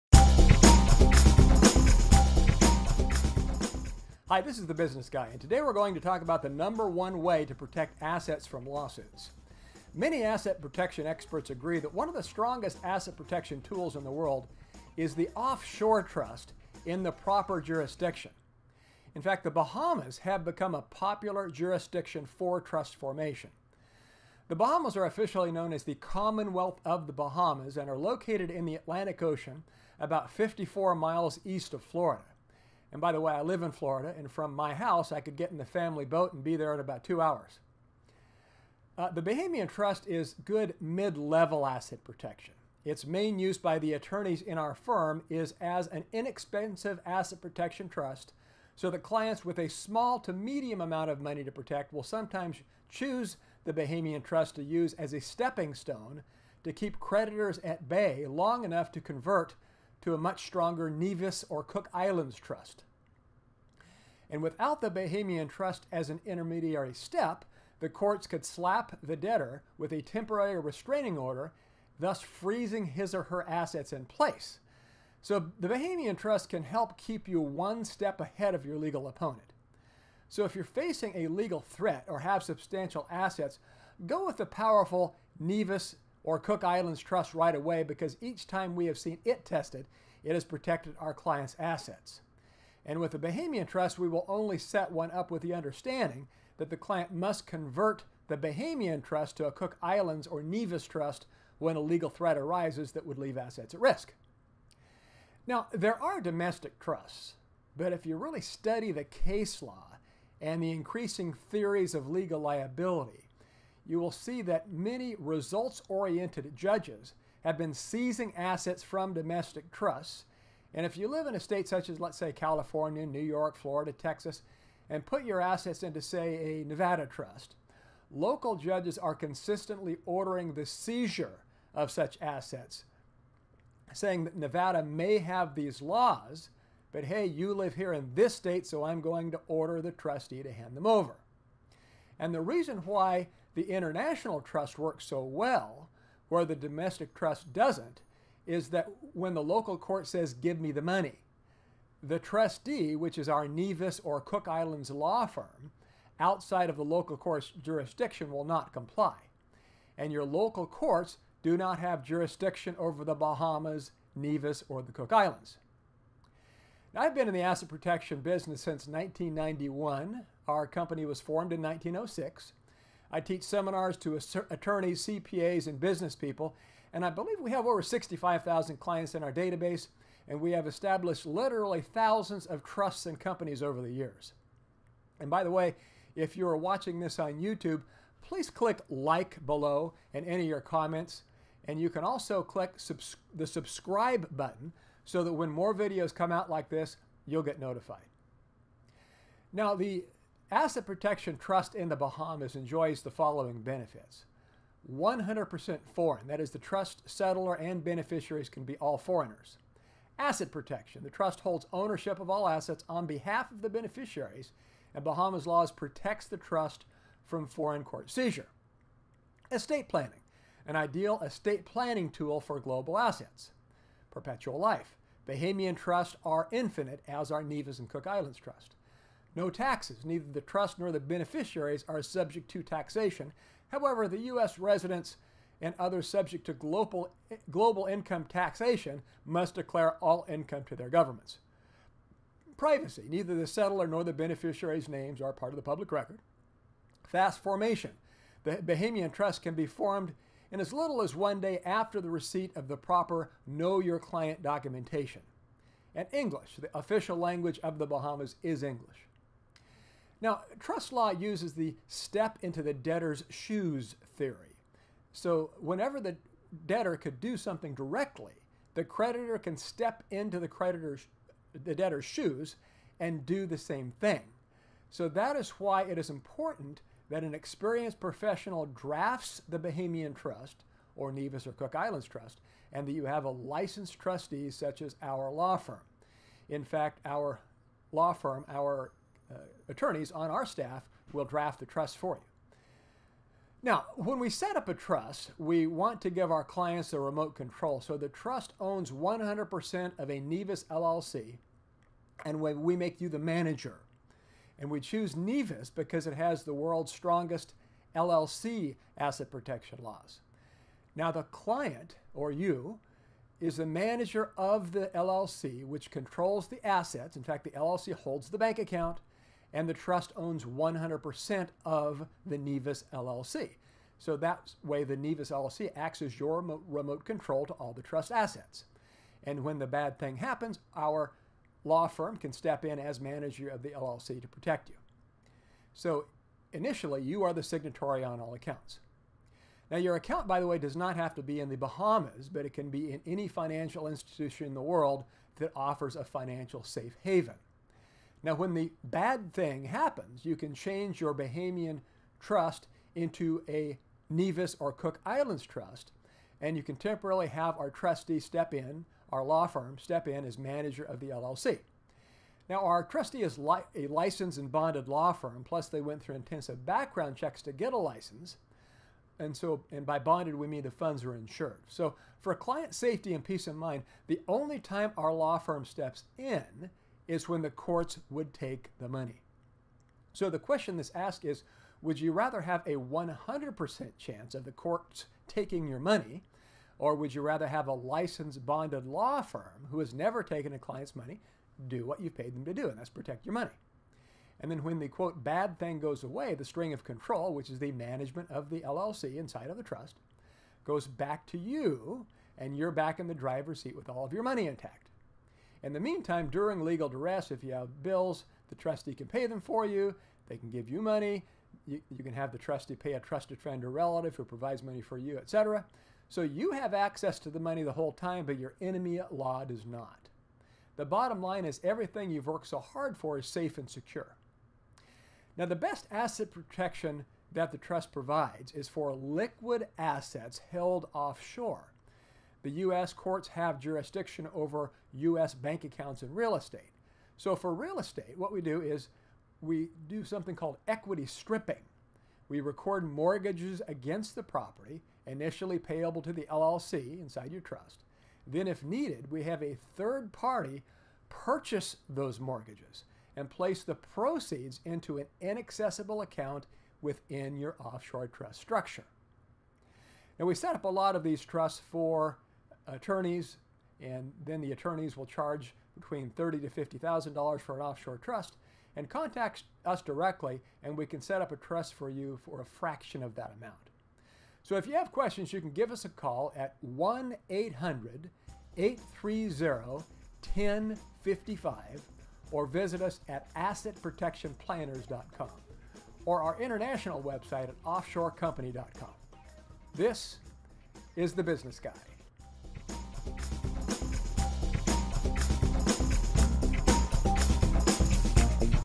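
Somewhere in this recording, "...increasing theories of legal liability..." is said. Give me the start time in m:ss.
1:50.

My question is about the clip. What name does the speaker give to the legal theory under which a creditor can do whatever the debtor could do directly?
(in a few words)
step into the debtor's shoes.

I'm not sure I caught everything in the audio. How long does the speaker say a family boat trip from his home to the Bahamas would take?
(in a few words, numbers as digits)
2 hours.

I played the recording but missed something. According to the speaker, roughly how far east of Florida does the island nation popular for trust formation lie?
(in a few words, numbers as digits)
54 miles.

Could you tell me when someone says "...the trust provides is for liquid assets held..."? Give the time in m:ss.
7:07.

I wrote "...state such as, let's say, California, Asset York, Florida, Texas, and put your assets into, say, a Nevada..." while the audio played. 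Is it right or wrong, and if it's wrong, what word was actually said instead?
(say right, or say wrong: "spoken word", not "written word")
wrong: "New", not "Asset".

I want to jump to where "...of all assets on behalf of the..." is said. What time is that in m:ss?
3:32.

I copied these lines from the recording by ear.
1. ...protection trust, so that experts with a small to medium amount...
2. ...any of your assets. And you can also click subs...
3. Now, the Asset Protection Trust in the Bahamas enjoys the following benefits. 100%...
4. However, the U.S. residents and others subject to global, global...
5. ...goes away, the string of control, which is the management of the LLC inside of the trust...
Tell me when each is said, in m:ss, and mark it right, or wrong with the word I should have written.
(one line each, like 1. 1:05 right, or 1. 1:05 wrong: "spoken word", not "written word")
1. 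0:47 wrong: "clients", not "experts"
2. 3:10 wrong: "comments", not "assets"
3. 3:19 right
4. 3:53 right
5. 6:35 right.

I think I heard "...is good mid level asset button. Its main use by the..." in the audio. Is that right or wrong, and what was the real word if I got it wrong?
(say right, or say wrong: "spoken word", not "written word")
wrong: "protection", not "button".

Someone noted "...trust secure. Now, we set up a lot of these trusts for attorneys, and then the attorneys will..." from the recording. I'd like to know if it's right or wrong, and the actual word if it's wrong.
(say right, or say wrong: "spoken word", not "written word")
wrong: "structure", not "secure".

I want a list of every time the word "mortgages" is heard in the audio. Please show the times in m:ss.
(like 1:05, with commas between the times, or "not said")
7:22, 7:32.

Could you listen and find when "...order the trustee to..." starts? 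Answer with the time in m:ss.
2:19.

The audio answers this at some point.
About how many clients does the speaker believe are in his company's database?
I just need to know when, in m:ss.
2:57.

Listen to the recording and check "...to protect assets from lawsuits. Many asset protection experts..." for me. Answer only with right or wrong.
right.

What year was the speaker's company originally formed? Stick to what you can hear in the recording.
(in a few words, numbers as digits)
1906.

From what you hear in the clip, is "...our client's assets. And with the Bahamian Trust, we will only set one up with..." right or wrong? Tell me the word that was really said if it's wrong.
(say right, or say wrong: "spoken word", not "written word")
right.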